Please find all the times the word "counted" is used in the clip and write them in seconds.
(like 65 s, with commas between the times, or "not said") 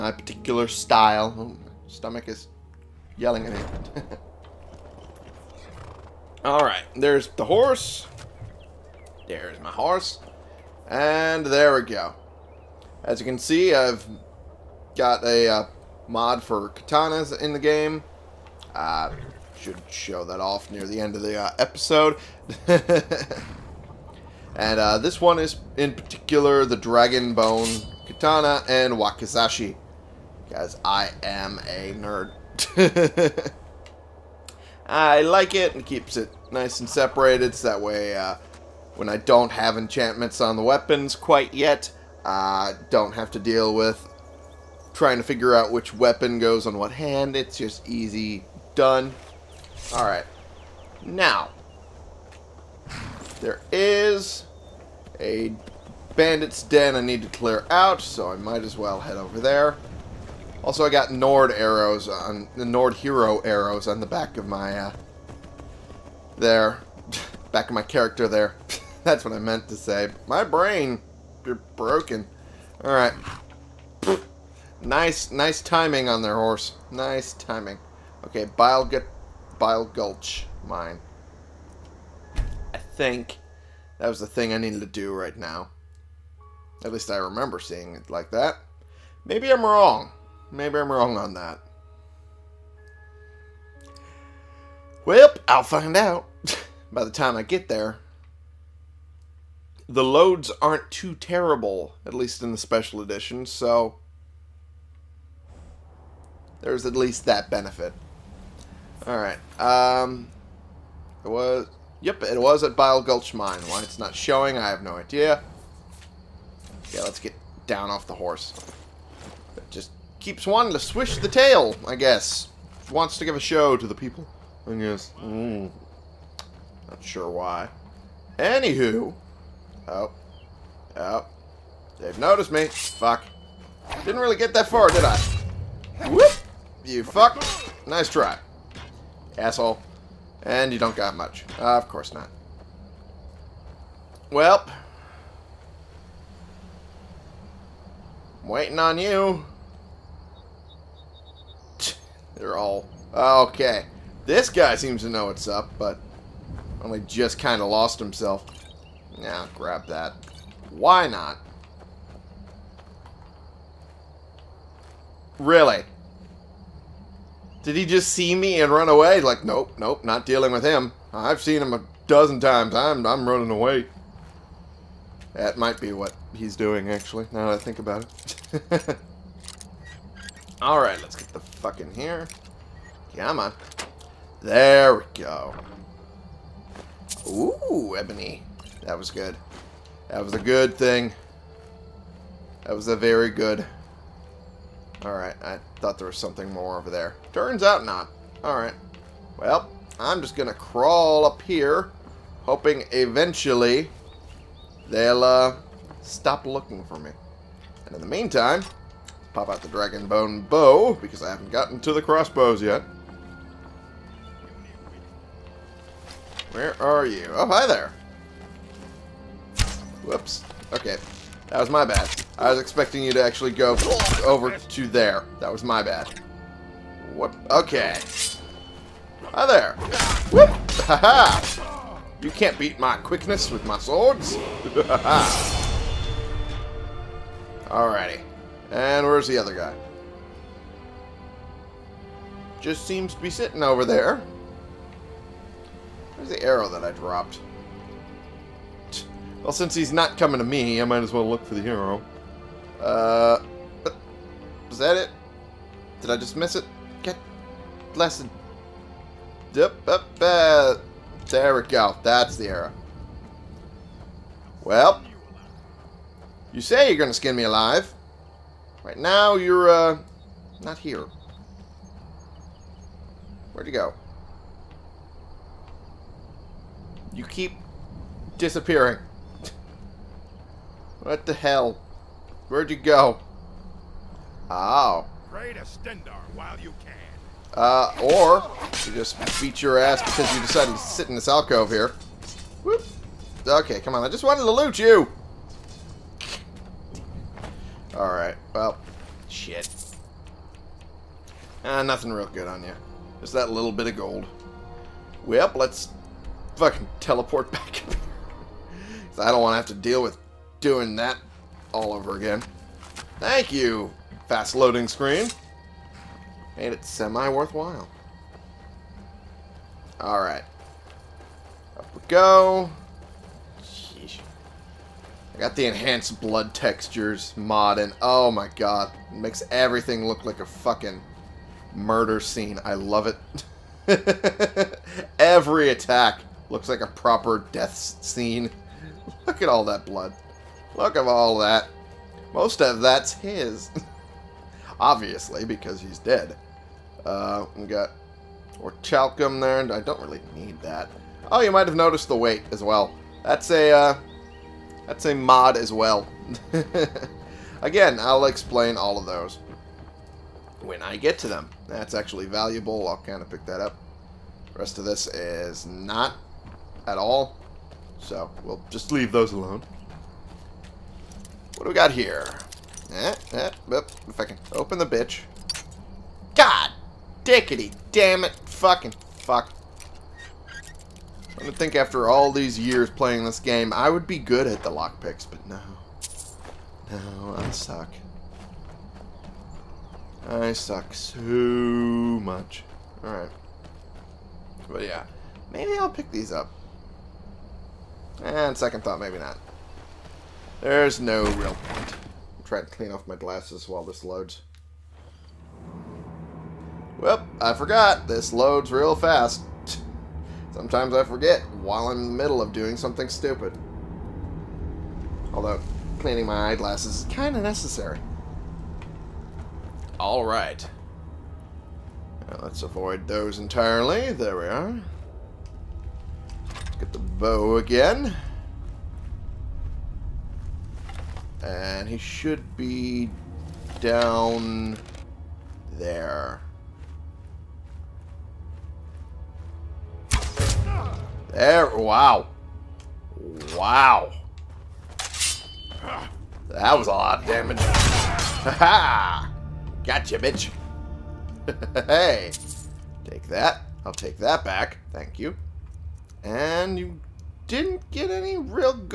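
not said.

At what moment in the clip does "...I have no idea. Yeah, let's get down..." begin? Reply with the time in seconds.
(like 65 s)
114 s.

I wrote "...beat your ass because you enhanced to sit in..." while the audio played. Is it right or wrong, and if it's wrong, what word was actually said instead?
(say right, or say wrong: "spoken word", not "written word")
wrong: "decided", not "enhanced".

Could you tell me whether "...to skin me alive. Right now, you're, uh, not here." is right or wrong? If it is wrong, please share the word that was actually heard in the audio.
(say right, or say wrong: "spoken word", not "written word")
right.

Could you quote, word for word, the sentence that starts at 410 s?
Sometimes I forget while I'm in the middle of doing something stupid.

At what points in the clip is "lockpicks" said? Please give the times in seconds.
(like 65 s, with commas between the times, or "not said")
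384 s.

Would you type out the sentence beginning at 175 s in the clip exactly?
That might be what he's doing, actually, now that I think about it.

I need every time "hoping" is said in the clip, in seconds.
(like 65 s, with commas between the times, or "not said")
202 s.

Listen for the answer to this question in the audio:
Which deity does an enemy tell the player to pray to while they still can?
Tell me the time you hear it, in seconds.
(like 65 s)
285 s.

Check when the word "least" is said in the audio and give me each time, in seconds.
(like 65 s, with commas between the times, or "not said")
86 s, 102 s, 106 s.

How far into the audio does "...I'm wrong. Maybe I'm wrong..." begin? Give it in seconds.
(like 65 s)
89 s.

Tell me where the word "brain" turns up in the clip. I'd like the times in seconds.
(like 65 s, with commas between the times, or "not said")
70 s.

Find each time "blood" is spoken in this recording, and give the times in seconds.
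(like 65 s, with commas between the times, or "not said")
326 s, 339 s.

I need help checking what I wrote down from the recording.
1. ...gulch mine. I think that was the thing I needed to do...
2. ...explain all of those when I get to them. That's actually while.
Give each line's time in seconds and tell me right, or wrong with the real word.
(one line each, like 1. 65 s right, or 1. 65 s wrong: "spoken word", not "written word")
1. 79 s right
2. 358 s wrong: "valuable", not "while".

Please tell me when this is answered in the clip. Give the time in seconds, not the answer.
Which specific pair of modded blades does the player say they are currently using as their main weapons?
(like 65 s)
26 s.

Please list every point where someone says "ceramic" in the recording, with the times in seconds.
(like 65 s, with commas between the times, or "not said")
not said.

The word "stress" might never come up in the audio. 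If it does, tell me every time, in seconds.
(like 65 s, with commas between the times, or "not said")
not said.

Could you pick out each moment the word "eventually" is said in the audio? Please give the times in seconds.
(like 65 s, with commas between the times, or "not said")
202 s.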